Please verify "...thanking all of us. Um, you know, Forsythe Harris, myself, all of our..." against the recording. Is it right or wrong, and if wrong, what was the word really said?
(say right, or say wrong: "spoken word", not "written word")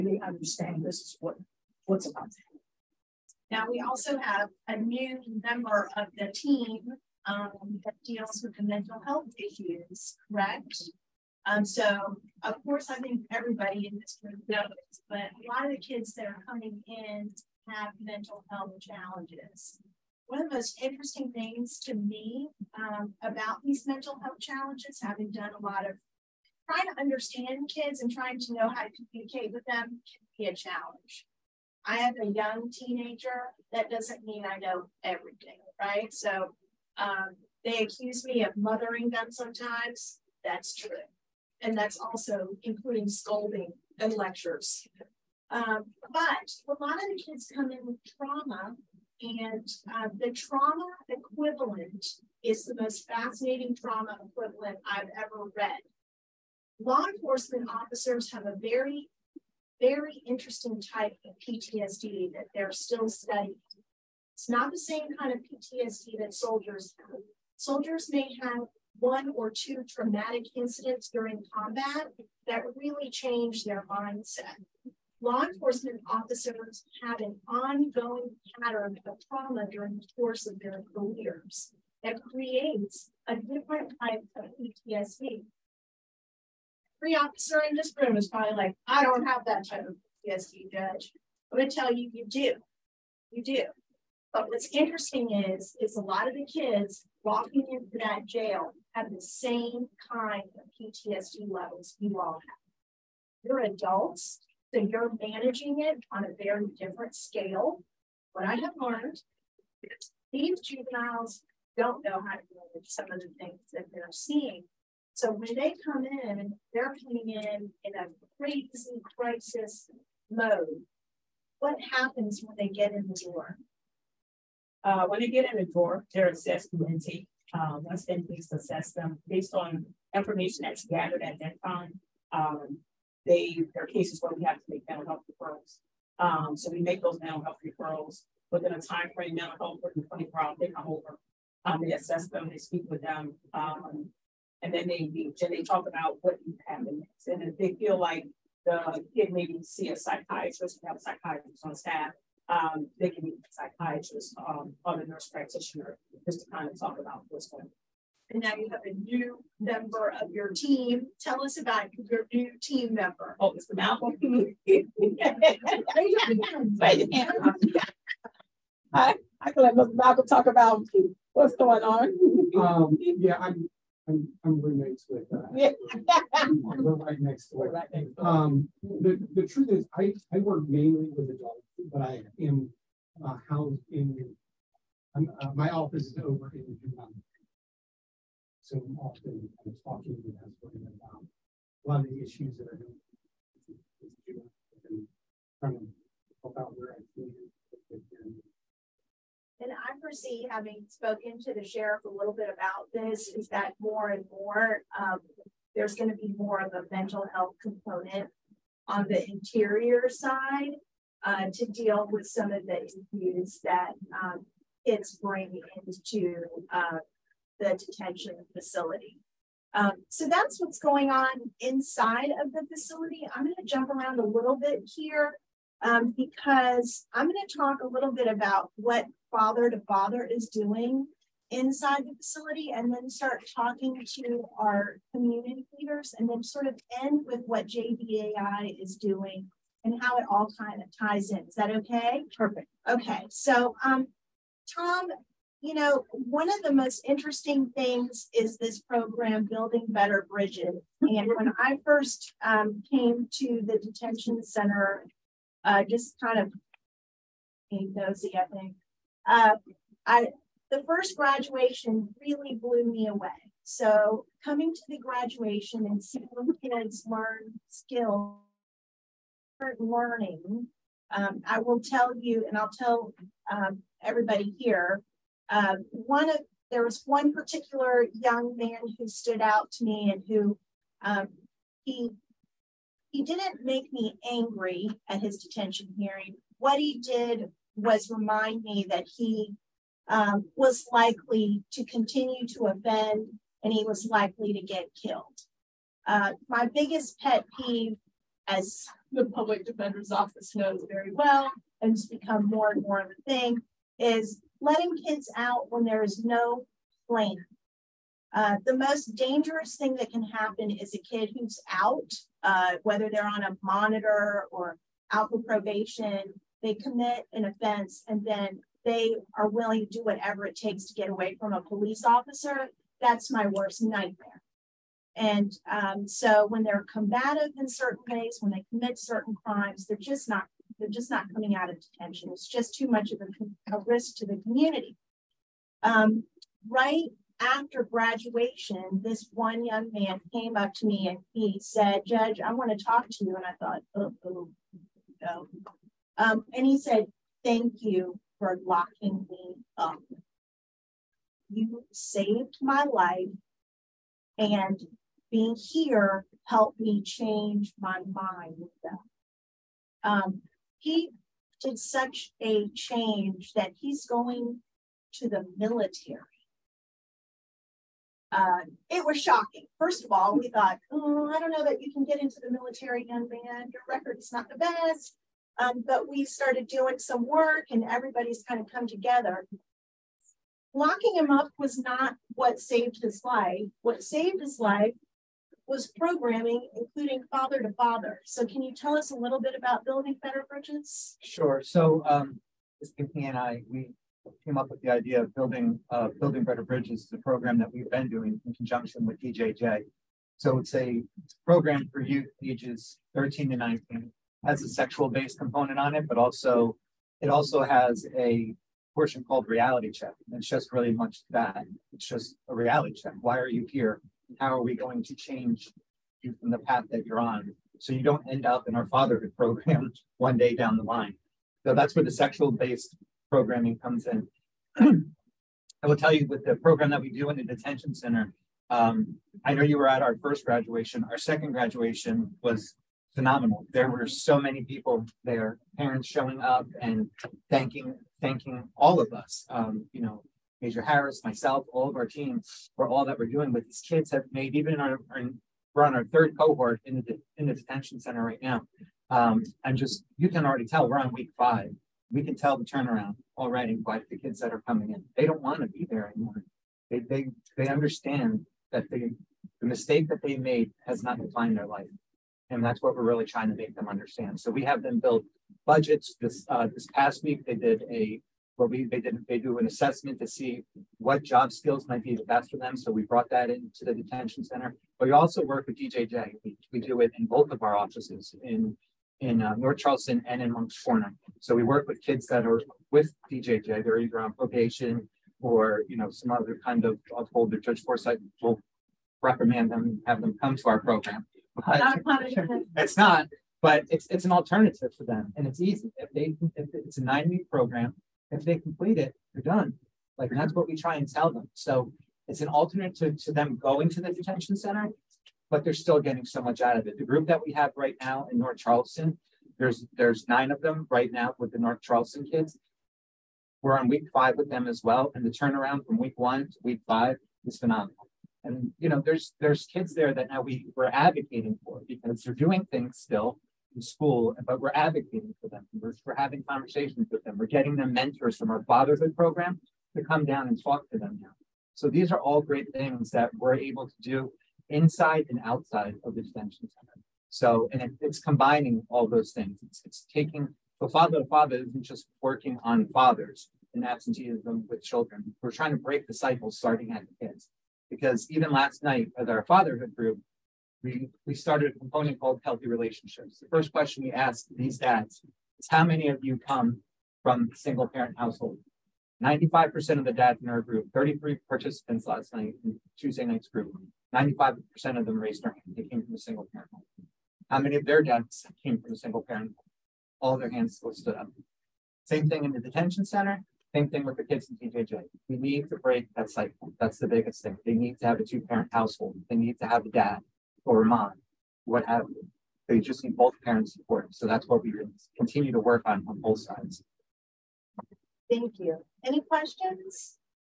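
wrong: "Major", not "Forsythe".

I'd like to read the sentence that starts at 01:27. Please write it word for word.
Every officer in this room is probably like, I don't have that type of PTSD, Judge.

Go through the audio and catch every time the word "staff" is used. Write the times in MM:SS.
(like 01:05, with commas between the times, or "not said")
02:31.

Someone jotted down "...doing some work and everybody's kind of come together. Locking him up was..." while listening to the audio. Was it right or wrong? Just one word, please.
right.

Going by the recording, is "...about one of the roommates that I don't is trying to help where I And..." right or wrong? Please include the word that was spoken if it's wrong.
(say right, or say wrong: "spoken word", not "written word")
wrong: "issues", not "roommates".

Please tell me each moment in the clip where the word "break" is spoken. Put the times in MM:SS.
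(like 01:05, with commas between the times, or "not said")
09:05, 09:35.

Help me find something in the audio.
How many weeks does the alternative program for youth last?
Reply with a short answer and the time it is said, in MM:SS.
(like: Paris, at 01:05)
9, at 08:17.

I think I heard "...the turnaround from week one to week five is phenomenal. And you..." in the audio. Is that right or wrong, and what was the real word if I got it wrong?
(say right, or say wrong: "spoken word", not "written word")
right.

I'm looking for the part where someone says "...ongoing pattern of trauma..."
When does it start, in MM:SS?
01:17.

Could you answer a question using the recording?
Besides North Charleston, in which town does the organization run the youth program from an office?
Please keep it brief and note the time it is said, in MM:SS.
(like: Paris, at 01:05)
Moncks Corner, at 08:00.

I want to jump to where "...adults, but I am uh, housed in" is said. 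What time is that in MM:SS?
03:01.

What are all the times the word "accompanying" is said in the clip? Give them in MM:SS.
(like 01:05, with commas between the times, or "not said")
not said.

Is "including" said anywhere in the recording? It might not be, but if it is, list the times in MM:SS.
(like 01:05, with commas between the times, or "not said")
00:42, 06:26.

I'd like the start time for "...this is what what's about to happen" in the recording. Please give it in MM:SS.
00:00.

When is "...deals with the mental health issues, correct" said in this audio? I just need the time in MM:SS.
00:08.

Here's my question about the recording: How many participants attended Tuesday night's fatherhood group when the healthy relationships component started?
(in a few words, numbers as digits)
33.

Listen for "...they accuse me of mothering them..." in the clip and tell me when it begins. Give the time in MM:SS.
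00:37.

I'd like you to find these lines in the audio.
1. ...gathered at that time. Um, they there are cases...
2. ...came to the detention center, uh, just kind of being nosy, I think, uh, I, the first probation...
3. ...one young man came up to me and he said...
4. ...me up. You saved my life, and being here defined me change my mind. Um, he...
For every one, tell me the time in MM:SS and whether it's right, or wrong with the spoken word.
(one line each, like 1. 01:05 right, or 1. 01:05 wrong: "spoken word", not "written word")
1. 02:10 right
2. 04:12 wrong: "graduation", not "probation"
3. 05:39 right
4. 05:49 wrong: "helped", not "defined".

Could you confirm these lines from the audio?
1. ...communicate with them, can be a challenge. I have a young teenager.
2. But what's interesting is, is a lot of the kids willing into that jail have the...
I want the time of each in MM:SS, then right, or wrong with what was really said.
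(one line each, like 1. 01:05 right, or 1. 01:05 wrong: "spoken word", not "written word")
1. 00:29 right
2. 01:34 wrong: "walking", not "willing".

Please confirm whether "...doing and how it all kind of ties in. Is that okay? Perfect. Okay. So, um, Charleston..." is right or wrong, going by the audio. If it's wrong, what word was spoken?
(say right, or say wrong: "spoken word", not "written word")
wrong: "Tom", not "Charleston".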